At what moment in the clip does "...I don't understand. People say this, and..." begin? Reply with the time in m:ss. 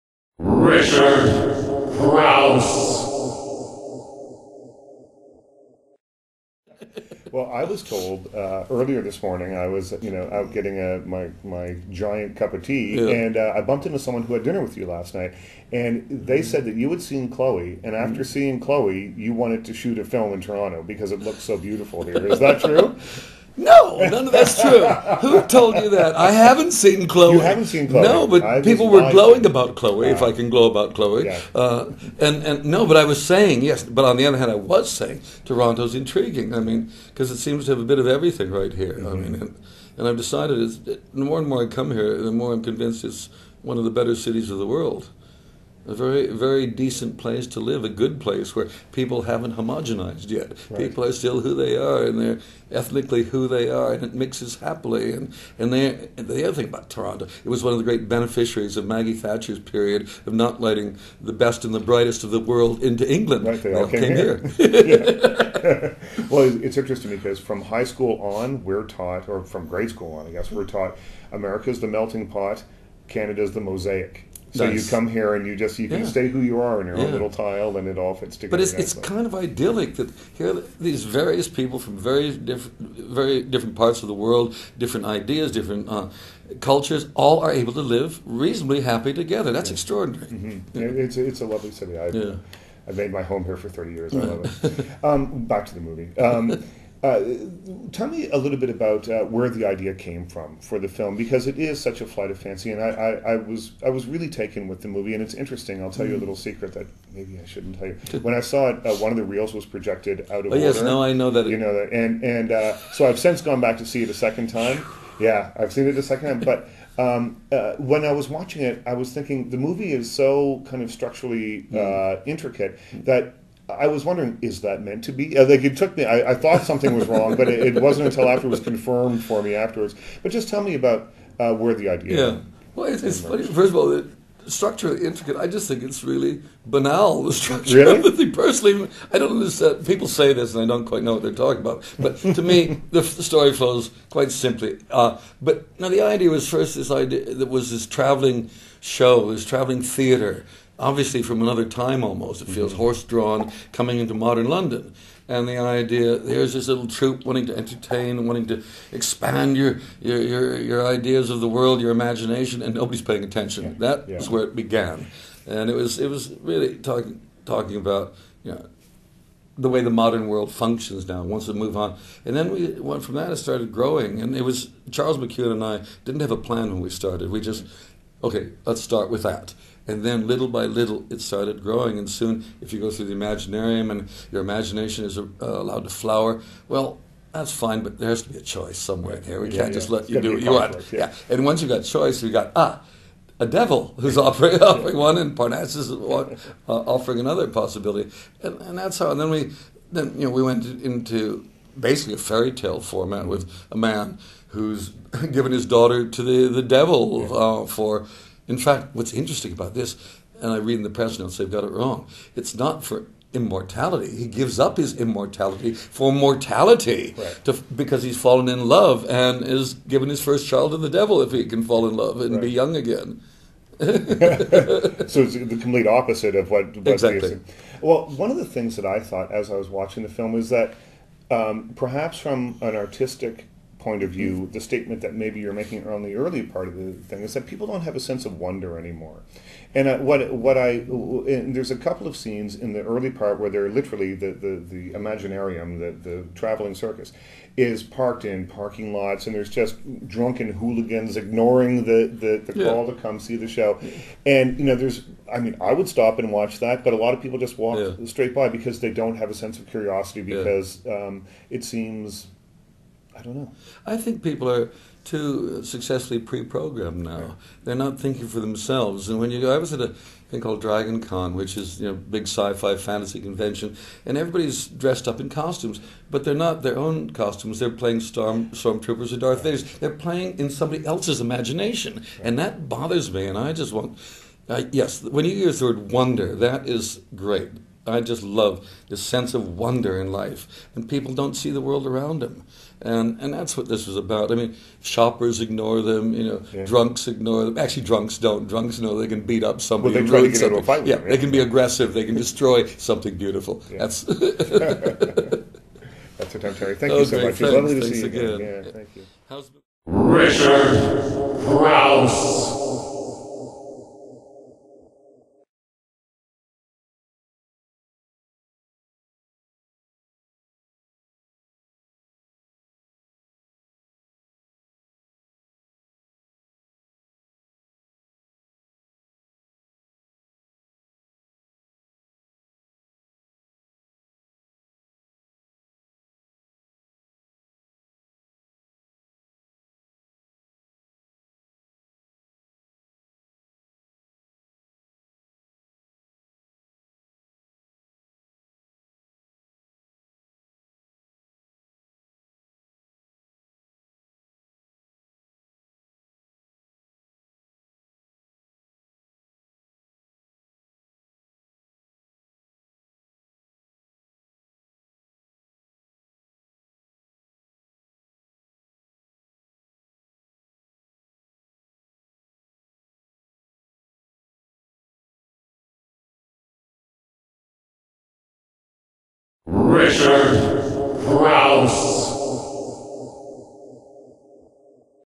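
2:19.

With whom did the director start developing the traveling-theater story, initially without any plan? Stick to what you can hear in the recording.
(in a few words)
Charles McKeown.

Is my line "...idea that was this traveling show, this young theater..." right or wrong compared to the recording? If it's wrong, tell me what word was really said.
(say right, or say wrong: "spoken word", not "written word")
wrong: "traveling", not "young".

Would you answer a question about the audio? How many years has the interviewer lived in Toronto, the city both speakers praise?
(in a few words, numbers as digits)
30.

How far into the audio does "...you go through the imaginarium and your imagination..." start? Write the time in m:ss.
3:02.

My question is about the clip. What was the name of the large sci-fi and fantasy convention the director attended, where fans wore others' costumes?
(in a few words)
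Dragon Con.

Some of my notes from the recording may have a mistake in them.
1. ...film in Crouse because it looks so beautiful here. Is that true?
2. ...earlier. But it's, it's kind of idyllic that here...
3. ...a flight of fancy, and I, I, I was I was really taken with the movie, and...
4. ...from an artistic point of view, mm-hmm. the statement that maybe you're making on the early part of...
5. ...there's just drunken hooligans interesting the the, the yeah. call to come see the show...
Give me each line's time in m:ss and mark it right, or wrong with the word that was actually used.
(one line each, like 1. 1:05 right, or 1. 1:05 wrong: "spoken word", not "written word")
1. 0:20 wrong: "Toronto", not "Crouse"
2. 1:18 wrong: "together", not "earlier"
3. 1:41 right
4. 3:52 right
5. 4:09 wrong: "ignoring", not "interesting".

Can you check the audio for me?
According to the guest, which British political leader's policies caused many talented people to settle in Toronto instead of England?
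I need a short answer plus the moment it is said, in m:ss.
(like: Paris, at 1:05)
Maggie Thatcher, at 0:58.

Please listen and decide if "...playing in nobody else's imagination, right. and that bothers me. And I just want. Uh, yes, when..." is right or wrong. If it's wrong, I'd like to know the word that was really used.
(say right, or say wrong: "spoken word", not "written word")
wrong: "somebody", not "nobody".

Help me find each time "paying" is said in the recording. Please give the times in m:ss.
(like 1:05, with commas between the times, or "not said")
2:43.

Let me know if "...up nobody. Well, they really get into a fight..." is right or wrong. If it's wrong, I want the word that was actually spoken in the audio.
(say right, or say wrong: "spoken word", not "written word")
wrong: "somebody", not "nobody".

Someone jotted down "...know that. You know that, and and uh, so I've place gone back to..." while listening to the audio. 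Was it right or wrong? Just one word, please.
wrong.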